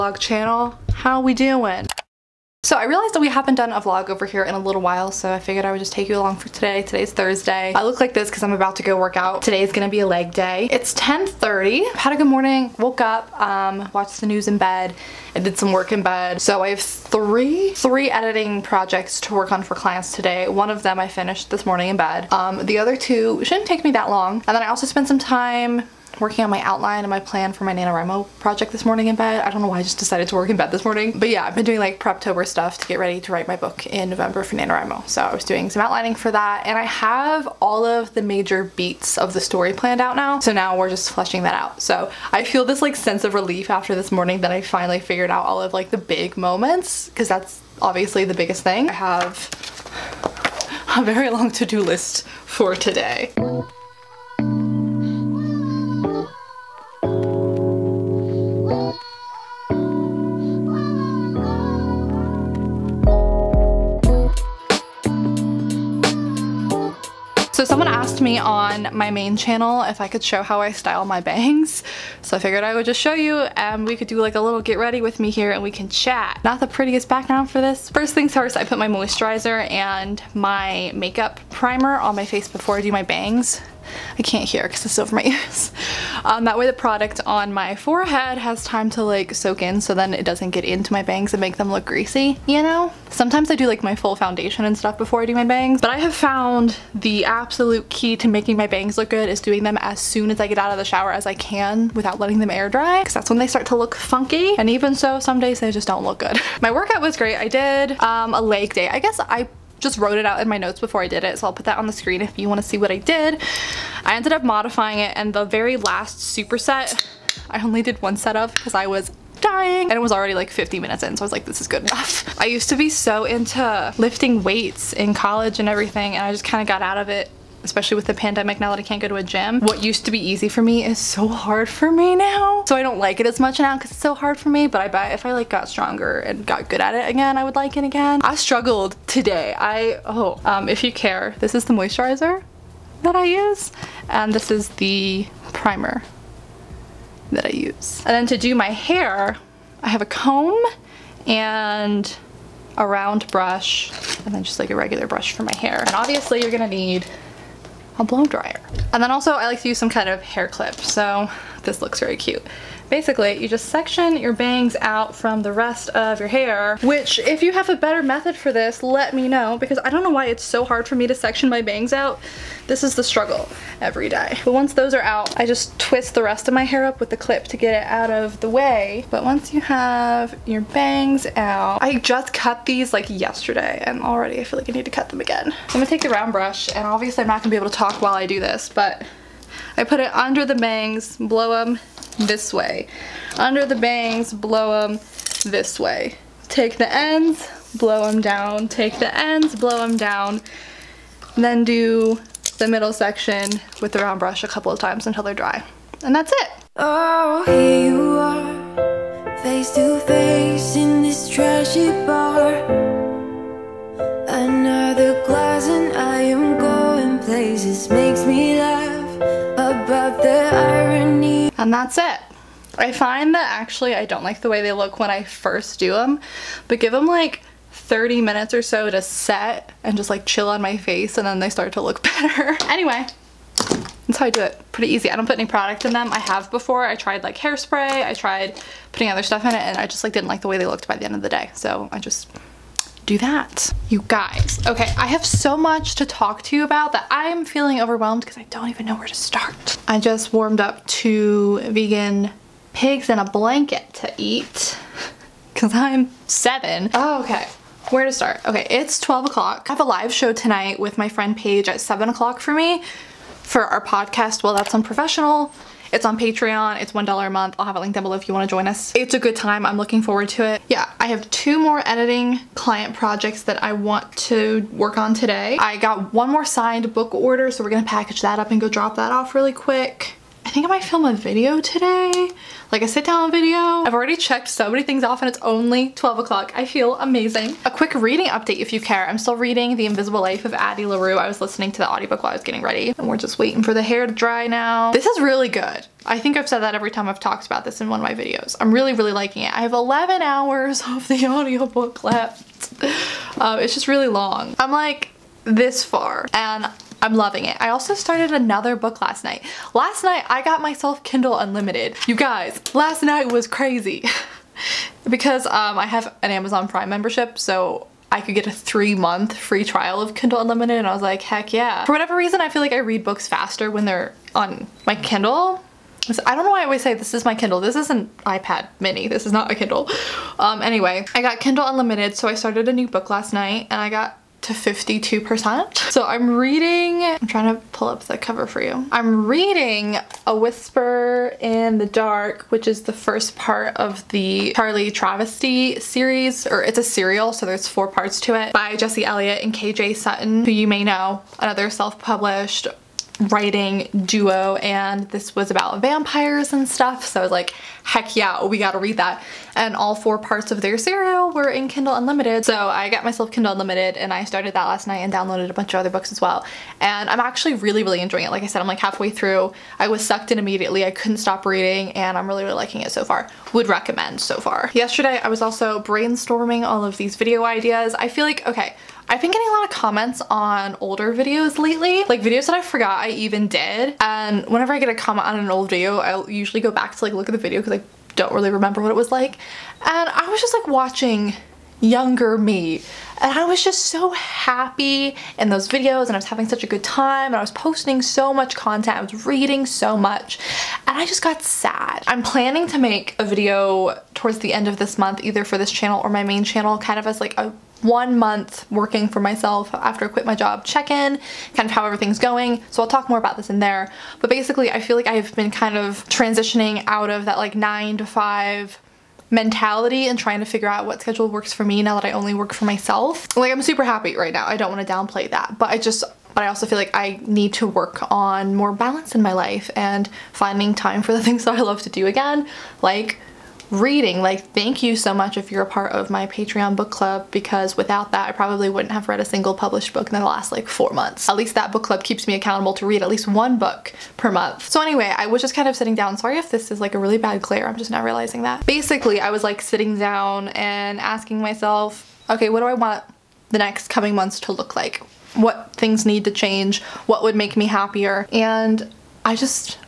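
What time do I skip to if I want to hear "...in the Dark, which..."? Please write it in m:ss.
5:41.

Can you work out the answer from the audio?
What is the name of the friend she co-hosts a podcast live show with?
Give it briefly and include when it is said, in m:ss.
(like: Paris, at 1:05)
Paige, at 4:21.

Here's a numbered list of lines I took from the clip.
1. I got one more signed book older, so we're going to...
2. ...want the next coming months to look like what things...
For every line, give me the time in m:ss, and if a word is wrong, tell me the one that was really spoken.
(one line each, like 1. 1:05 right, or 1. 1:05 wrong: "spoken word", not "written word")
1. 4:35 wrong: "order", not "older"
2. 7:32 right.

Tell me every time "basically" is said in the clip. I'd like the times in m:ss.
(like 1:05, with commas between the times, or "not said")
2:42, 6:54, 7:28.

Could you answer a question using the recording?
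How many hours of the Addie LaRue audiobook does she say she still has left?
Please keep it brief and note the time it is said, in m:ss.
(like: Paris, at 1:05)
11, at 4:59.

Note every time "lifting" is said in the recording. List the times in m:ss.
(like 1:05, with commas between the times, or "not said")
2:03.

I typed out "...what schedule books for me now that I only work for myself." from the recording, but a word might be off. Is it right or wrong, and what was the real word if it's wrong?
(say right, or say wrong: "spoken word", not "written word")
wrong: "works", not "books".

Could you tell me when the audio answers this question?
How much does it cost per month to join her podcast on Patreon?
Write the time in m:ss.
4:26.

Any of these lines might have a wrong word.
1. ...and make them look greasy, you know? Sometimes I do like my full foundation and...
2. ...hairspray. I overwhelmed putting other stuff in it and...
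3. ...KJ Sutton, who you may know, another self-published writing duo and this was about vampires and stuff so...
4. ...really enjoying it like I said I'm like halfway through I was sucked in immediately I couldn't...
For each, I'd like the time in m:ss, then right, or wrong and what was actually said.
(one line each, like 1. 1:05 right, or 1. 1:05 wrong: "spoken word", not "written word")
1. 1:31 right
2. 3:57 wrong: "tried", not "overwhelmed"
3. 5:49 right
4. 6:07 right.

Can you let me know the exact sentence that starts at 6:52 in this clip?
So I'll talk more about this in there.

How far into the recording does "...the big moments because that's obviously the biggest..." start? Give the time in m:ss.
0:45.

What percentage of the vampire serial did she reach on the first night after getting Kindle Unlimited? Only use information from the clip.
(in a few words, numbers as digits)
52%.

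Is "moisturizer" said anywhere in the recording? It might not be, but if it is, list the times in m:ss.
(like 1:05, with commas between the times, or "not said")
1:18, 2:21.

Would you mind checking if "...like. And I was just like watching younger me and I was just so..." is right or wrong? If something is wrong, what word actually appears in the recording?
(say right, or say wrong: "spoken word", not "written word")
right.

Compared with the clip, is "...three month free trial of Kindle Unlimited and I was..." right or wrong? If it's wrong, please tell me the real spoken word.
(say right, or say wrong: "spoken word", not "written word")
right.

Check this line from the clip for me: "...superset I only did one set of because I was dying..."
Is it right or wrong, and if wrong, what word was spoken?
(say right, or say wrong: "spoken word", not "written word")
right.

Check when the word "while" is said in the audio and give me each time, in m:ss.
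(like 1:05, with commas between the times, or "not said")
0:04, 3:08, 4:52.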